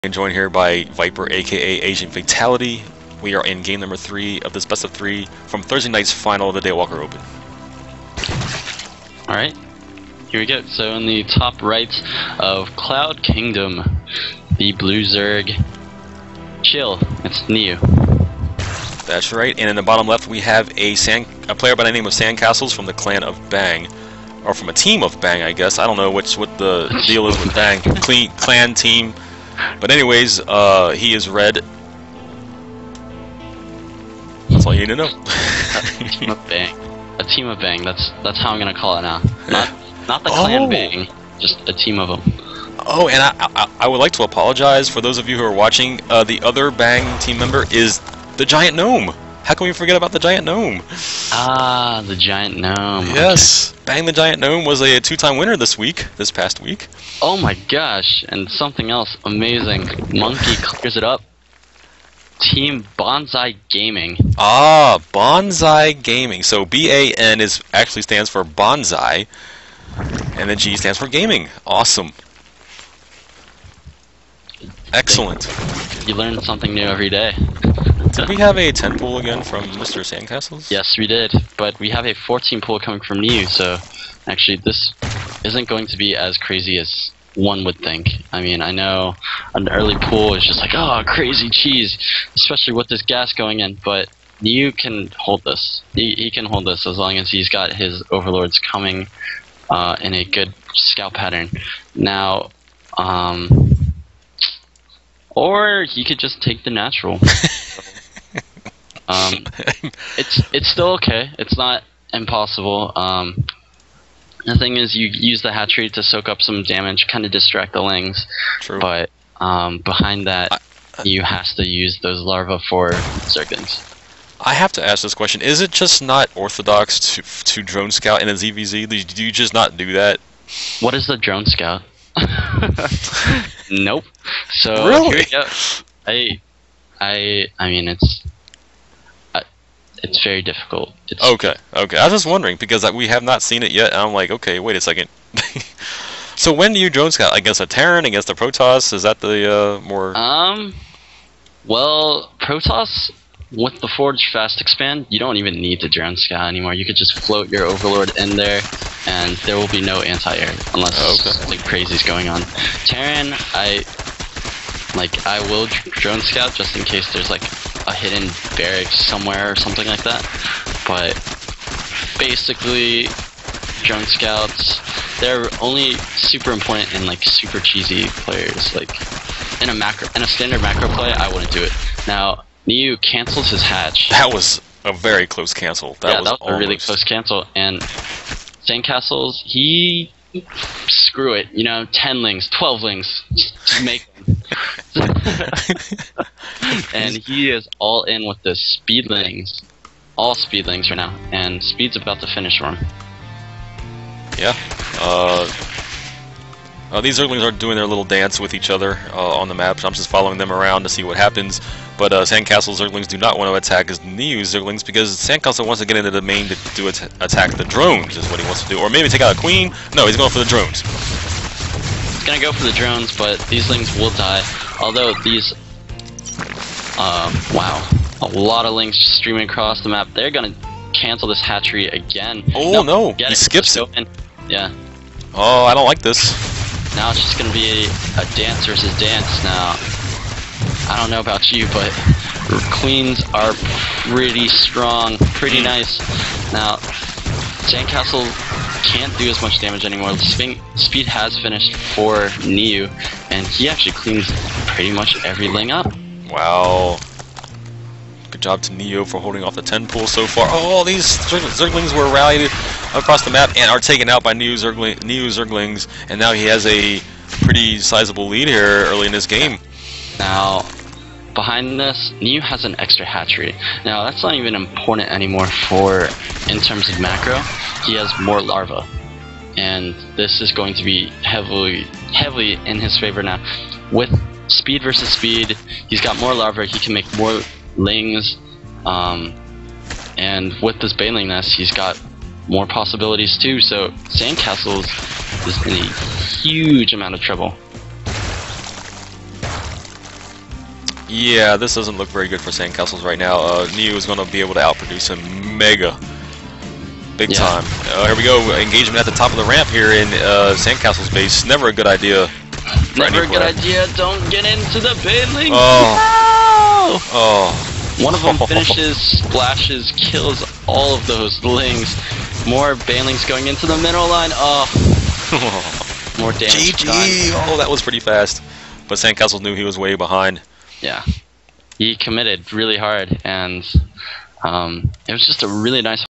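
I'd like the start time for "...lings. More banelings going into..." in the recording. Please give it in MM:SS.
05:21.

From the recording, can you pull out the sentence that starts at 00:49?
How can we forget about the giant gnome?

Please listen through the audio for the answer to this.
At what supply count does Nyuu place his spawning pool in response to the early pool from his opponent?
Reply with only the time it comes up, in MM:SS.
01:22.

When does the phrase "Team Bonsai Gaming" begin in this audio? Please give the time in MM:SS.
01:02.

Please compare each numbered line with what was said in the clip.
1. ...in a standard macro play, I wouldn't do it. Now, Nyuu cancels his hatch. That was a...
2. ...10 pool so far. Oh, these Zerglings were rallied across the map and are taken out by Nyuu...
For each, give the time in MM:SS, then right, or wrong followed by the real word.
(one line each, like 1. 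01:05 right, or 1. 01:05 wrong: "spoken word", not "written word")
1. 03:00 right
2. 04:19 right.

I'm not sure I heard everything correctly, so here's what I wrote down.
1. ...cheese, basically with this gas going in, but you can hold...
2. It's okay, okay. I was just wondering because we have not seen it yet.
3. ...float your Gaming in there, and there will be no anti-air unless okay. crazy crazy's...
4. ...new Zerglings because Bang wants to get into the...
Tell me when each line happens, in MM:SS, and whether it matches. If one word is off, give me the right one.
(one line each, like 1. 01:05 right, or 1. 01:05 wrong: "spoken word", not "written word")
1. 01:31 wrong: "especially", not "basically"
2. 02:21 right
3. 02:37 wrong: "Overlord", not "Gaming"
4. 03:34 wrong: "Sandcastle", not "Bang".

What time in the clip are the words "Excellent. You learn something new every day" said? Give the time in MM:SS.
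01:14.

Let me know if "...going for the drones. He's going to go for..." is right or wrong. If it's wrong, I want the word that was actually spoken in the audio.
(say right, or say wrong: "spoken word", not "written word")
right.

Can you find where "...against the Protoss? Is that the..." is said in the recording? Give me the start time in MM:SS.
02:28.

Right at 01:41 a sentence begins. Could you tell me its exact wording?
Now, um, or he could just take the natural.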